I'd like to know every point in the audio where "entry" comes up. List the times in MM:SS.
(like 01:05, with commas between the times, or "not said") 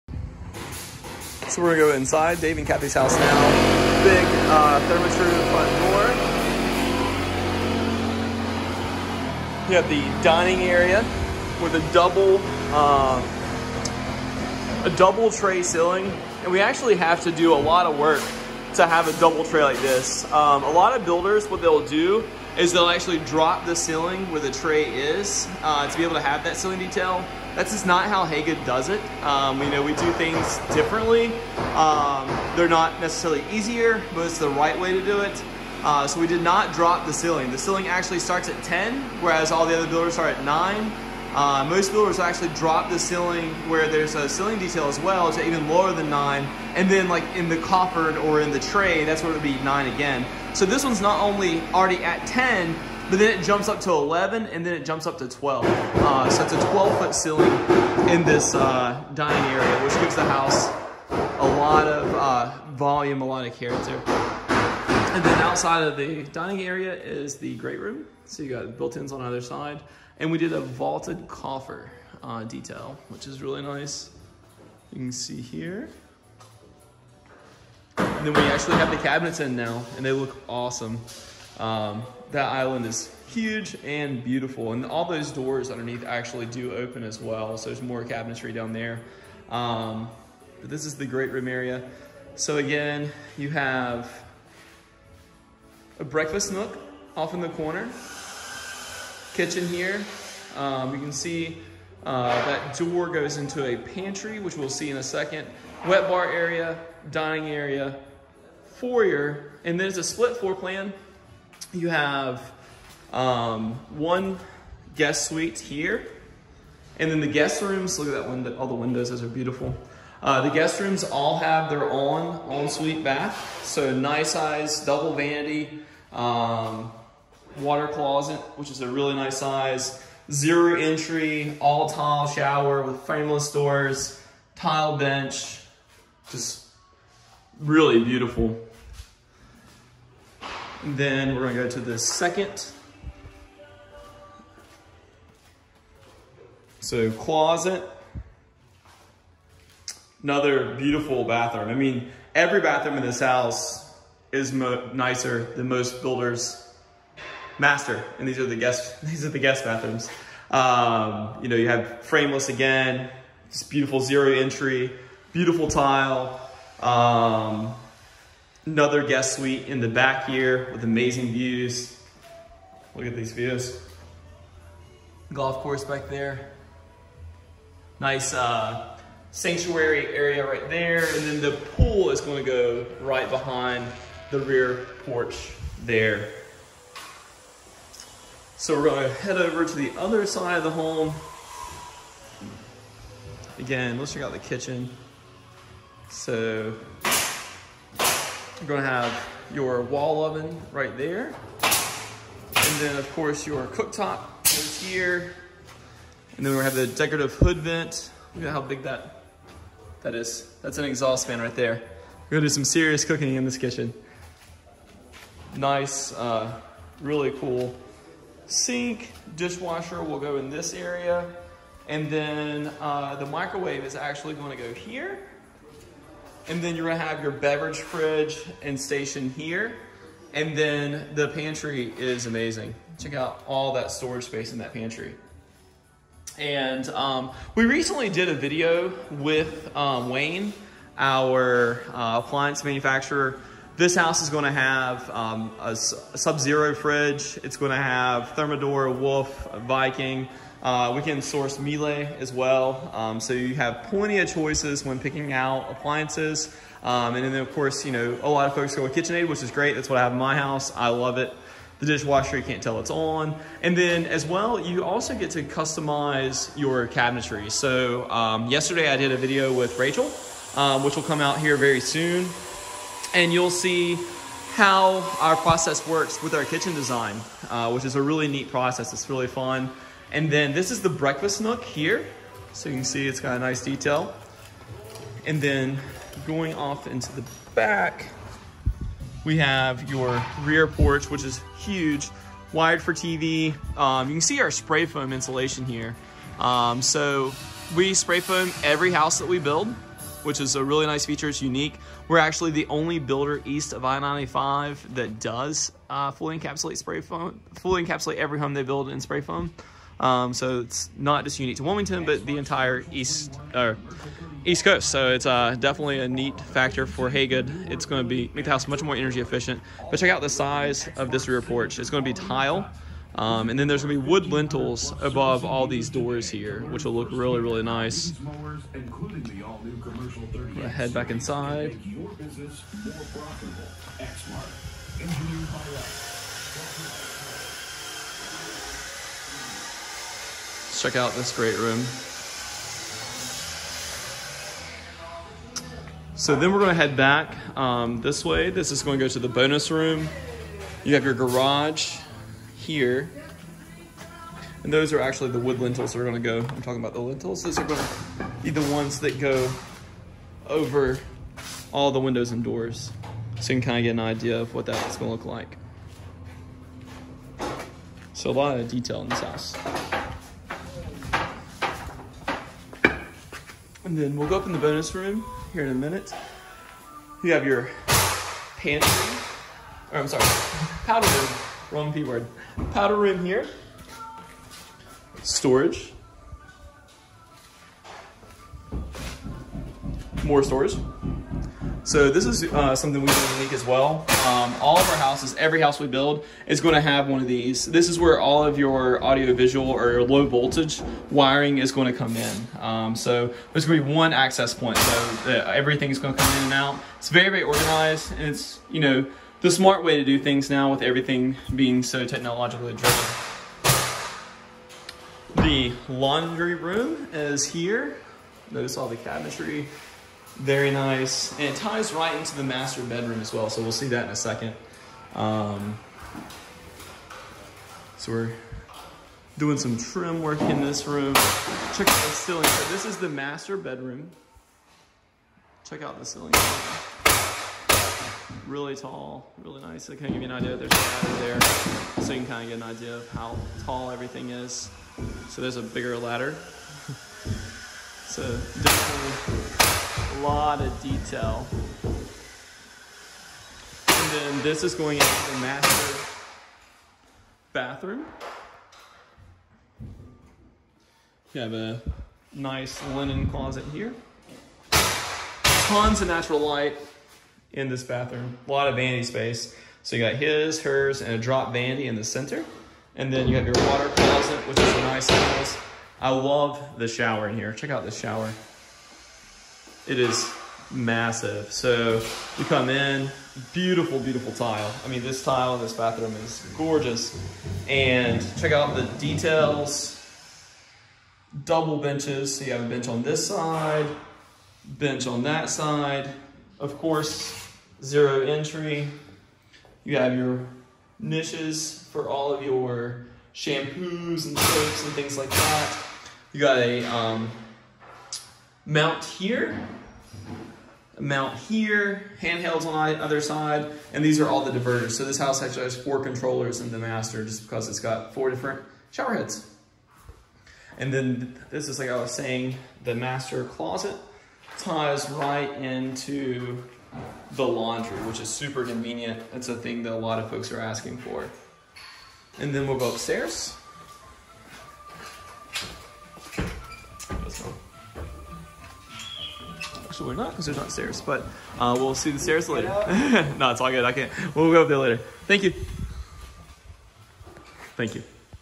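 02:10, 02:44, 08:18.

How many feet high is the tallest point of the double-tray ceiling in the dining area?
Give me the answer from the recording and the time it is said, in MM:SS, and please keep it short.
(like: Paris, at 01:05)
12, at 00:56.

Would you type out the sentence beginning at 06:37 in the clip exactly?
This is where all of your audio visual or your low voltage wiring is going to come in.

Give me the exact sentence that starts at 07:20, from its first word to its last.
There's a ladder there, so you can kind of get an idea of how tall everything is.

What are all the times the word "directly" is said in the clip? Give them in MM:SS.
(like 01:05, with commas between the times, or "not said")
not said.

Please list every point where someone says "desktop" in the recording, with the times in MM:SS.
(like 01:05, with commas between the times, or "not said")
not said.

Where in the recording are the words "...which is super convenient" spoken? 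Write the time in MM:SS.
08:48.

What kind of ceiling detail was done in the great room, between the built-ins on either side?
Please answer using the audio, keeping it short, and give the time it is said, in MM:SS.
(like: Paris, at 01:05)
vaulted coffer, at 01:10.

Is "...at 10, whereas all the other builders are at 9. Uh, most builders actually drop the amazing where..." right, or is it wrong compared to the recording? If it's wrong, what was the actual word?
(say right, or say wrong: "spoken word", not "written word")
wrong: "ceiling", not "amazing".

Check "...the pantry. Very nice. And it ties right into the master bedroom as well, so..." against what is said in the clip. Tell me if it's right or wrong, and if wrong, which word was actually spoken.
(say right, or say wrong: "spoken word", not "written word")
wrong: "cabinetry", not "pantry".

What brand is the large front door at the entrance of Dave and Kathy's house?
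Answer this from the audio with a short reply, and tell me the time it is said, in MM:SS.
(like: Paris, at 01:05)
Therma-Tru, at 00:04.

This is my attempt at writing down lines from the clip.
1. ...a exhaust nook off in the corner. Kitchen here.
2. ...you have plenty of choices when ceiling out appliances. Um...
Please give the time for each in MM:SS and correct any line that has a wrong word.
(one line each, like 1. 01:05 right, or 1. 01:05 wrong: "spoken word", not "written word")
1. 01:35 wrong: "breakfast", not "exhaust"
2. 04:13 wrong: "picking", not "ceiling".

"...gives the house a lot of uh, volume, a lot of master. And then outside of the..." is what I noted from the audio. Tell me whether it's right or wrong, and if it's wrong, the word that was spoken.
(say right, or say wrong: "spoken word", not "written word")
wrong: "character", not "master".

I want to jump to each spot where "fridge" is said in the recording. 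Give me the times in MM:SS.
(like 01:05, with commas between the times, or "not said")
03:47, 04:06.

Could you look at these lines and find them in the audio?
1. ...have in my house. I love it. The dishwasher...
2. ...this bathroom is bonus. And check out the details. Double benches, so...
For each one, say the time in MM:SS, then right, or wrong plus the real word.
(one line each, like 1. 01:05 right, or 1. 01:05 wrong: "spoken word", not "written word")
1. 04:20 right
2. 08:05 wrong: "gorgeous", not "bonus".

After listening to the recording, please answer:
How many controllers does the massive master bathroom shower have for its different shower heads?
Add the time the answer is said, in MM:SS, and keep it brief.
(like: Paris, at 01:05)
4, at 08:35.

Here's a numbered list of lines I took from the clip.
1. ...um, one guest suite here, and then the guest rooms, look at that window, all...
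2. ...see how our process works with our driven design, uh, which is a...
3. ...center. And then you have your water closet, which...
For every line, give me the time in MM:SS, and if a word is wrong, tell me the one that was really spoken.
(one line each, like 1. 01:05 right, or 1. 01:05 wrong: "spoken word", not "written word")
1. 01:53 right
2. 04:33 wrong: "kitchen", not "driven"
3. 07:52 right.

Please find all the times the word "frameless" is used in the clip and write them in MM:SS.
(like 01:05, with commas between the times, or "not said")
02:13, 02:42.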